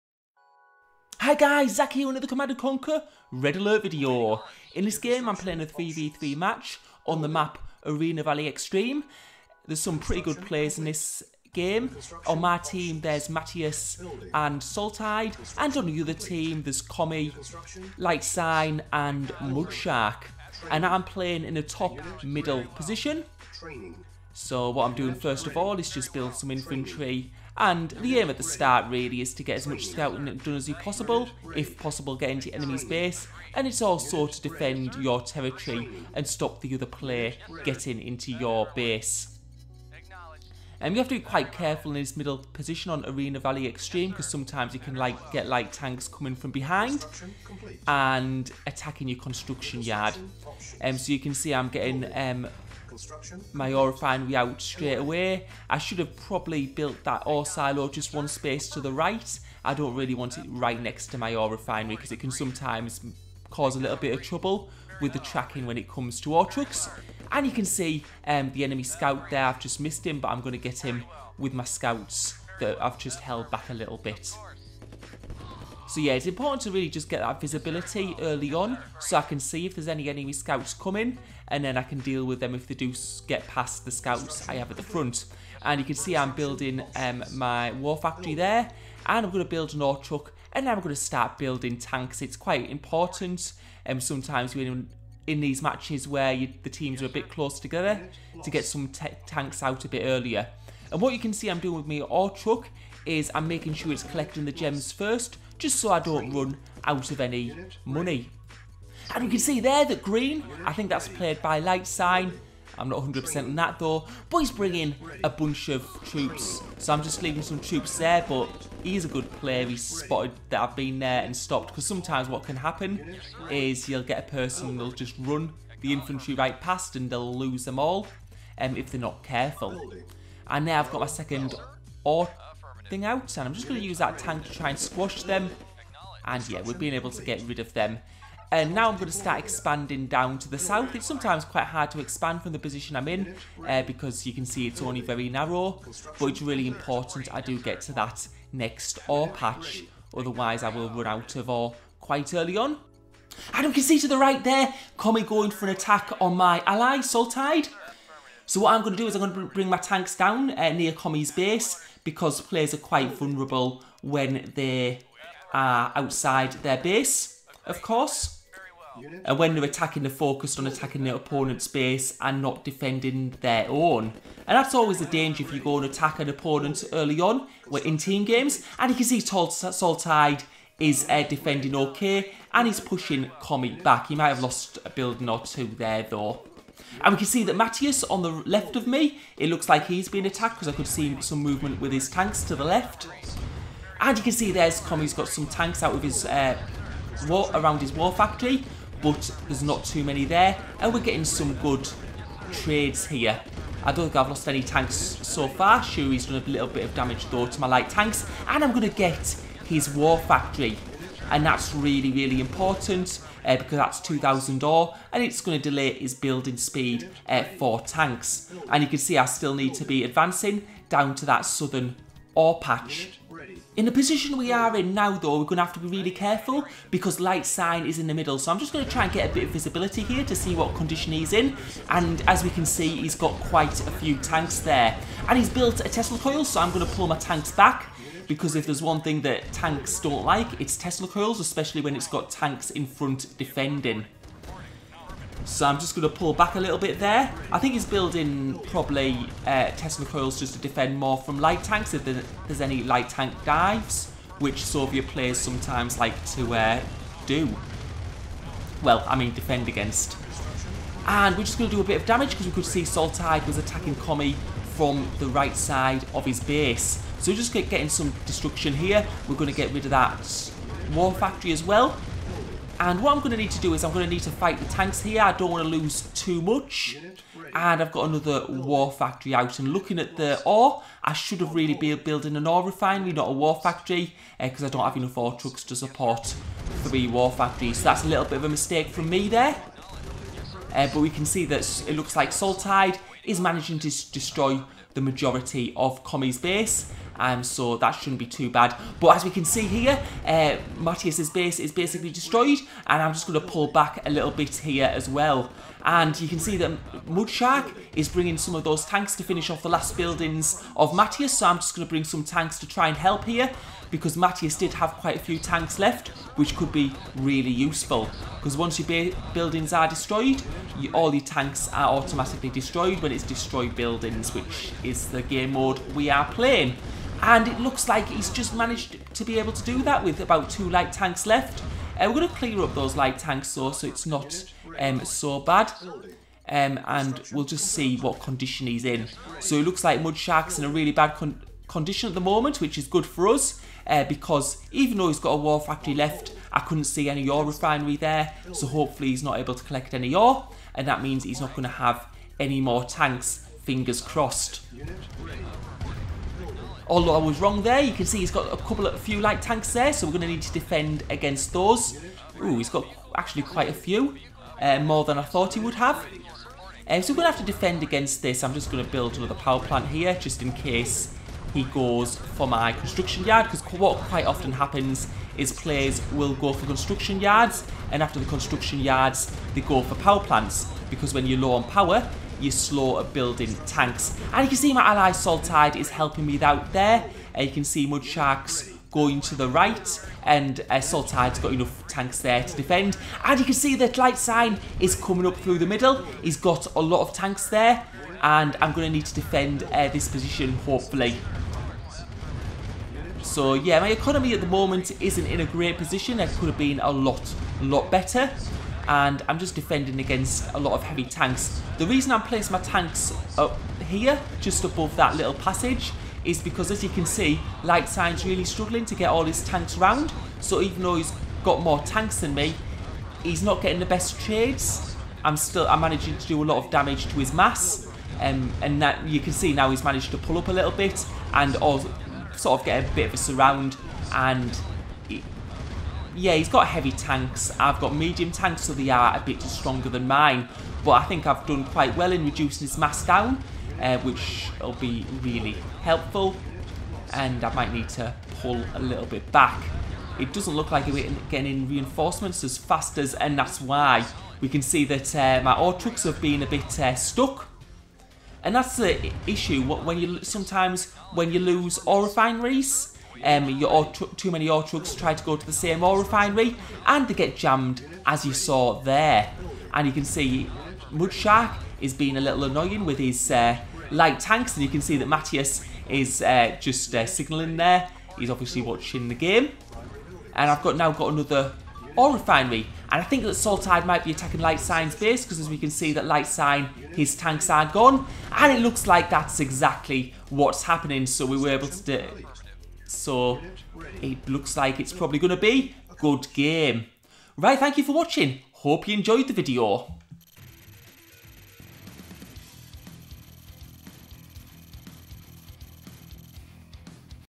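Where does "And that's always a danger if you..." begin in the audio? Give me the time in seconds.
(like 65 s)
174 s.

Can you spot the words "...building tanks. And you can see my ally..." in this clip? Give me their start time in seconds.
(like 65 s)
383 s.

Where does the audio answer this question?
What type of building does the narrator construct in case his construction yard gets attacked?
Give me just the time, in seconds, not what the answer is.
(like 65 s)
369 s.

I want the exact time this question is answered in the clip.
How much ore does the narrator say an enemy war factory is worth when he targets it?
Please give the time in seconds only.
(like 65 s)
214 s.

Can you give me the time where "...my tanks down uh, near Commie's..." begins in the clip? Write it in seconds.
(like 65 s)
159 s.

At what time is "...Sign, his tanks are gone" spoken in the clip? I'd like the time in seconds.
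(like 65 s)
486 s.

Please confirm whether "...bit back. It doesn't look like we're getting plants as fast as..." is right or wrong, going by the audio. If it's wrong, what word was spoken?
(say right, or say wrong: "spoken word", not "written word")
wrong: "reinforcements", not "plants".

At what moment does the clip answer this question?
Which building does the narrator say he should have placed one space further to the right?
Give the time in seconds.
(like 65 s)
57 s.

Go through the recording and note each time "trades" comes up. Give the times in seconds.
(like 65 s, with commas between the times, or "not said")
202 s, 424 s.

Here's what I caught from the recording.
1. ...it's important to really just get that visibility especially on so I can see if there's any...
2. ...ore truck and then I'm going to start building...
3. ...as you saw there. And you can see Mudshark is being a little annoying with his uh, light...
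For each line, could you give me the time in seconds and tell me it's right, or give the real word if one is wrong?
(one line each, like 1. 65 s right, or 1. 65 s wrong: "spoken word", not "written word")
1. 76 s wrong: "early", not "especially"
2. 89 s right
3. 468 s right.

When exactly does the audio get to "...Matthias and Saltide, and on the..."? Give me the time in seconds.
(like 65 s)
13 s.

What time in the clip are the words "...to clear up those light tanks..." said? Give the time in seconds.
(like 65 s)
332 s.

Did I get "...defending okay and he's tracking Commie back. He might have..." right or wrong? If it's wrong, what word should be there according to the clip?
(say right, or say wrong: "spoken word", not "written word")
wrong: "pushing", not "tracking".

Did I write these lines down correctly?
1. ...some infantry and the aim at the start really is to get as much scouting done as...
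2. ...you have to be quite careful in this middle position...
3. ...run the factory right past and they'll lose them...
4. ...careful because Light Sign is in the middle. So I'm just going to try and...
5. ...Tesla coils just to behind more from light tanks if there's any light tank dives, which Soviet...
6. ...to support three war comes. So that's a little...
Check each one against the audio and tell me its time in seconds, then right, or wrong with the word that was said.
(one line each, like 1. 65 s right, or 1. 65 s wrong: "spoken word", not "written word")
1. 26 s right
2. 40 s right
3. 125 s wrong: "infantry", not "factory"
4. 226 s right
5. 249 s wrong: "defend", not "behind"
6. 285 s wrong: "factories", not "comes".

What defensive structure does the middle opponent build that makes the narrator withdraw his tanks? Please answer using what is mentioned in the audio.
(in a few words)
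Tesla coil.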